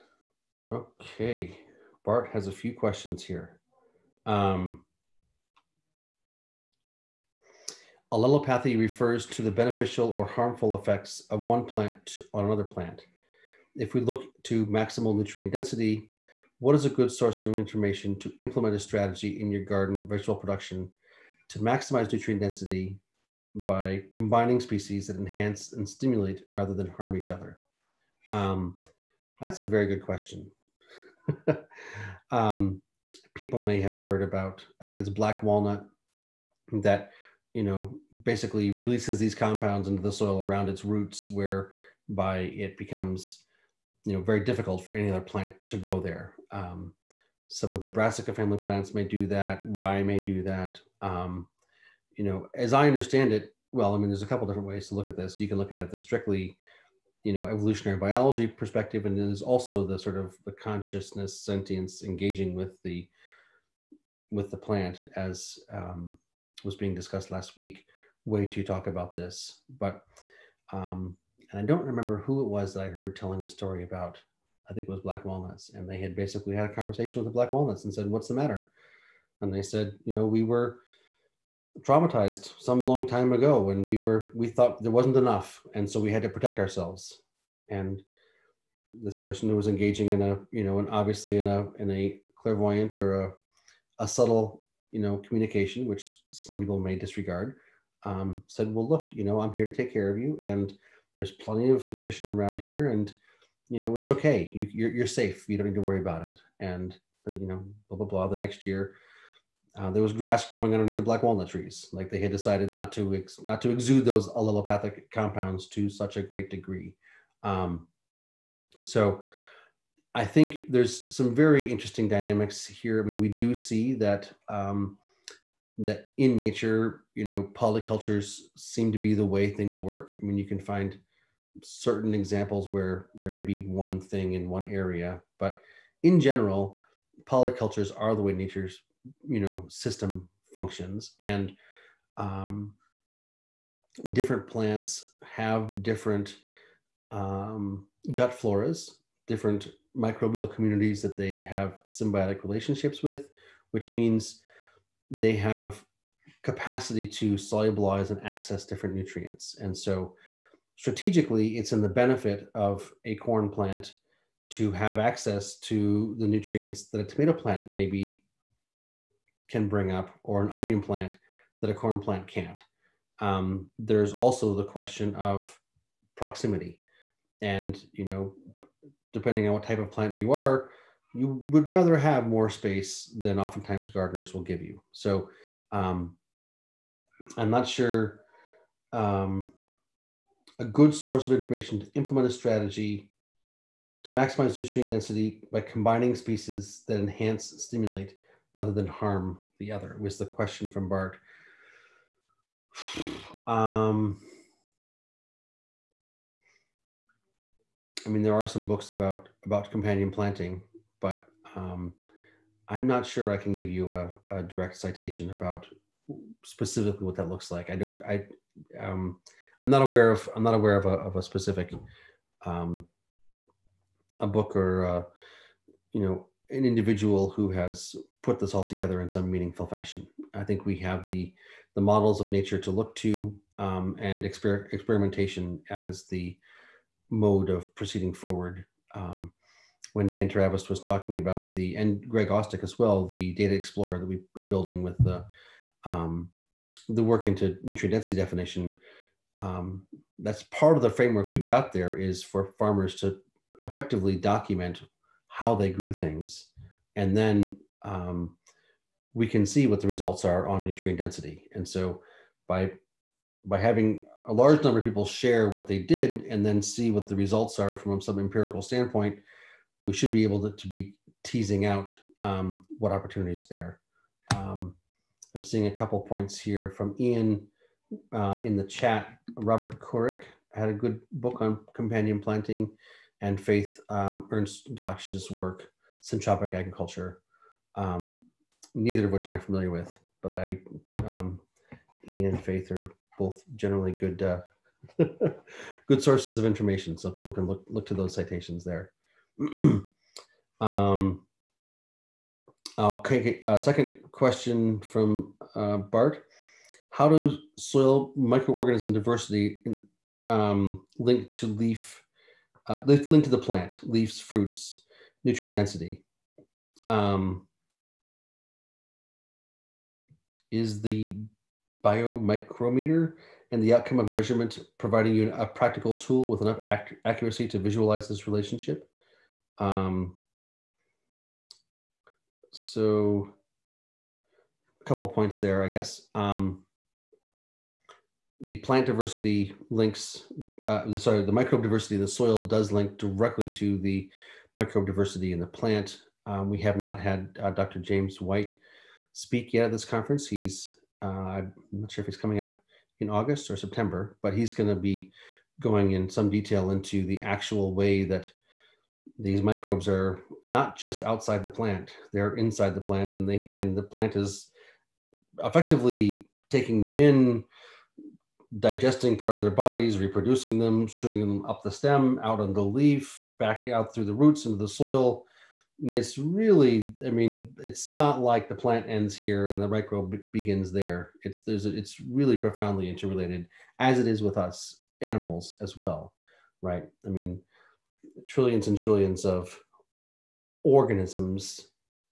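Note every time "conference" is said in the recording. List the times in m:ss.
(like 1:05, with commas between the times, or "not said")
5:49.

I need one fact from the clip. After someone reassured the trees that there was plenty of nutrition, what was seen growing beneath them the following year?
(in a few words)
Grass.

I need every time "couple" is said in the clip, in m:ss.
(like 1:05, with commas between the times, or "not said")
0:54, 4:35, 5:34.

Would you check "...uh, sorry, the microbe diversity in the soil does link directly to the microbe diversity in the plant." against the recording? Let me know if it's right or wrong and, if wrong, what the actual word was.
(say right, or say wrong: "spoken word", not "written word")
right.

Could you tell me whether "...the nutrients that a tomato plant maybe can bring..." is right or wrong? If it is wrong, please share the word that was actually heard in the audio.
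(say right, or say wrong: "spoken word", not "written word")
right.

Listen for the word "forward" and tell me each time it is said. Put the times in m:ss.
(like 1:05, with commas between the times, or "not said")
3:58.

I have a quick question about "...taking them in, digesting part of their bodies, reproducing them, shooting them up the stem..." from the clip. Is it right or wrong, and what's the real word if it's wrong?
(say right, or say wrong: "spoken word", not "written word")
right.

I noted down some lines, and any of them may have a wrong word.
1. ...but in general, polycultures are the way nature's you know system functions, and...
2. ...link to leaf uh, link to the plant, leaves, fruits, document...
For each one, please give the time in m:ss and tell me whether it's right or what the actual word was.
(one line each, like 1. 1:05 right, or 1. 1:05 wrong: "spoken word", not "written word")
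1. 2:15 right
2. 5:10 wrong: "nutrient", not "document".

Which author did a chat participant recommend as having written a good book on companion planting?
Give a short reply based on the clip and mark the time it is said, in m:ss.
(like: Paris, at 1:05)
Robert Kourik, at 4:39.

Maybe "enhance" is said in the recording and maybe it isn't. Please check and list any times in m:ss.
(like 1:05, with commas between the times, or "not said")
0:25, 3:16.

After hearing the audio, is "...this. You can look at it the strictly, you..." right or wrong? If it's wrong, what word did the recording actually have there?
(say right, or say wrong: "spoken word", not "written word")
right.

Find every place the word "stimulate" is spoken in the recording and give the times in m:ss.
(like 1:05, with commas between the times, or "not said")
0:25, 3:17.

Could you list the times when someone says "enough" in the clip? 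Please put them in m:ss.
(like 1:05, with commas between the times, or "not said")
1:25, 5:26.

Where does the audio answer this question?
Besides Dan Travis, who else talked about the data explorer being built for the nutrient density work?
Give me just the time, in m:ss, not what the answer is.
4:02.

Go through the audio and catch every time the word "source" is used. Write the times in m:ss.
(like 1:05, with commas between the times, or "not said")
0:17, 3:10, 4:56.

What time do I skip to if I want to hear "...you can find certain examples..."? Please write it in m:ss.
2:10.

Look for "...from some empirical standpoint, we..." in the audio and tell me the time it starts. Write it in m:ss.
4:27.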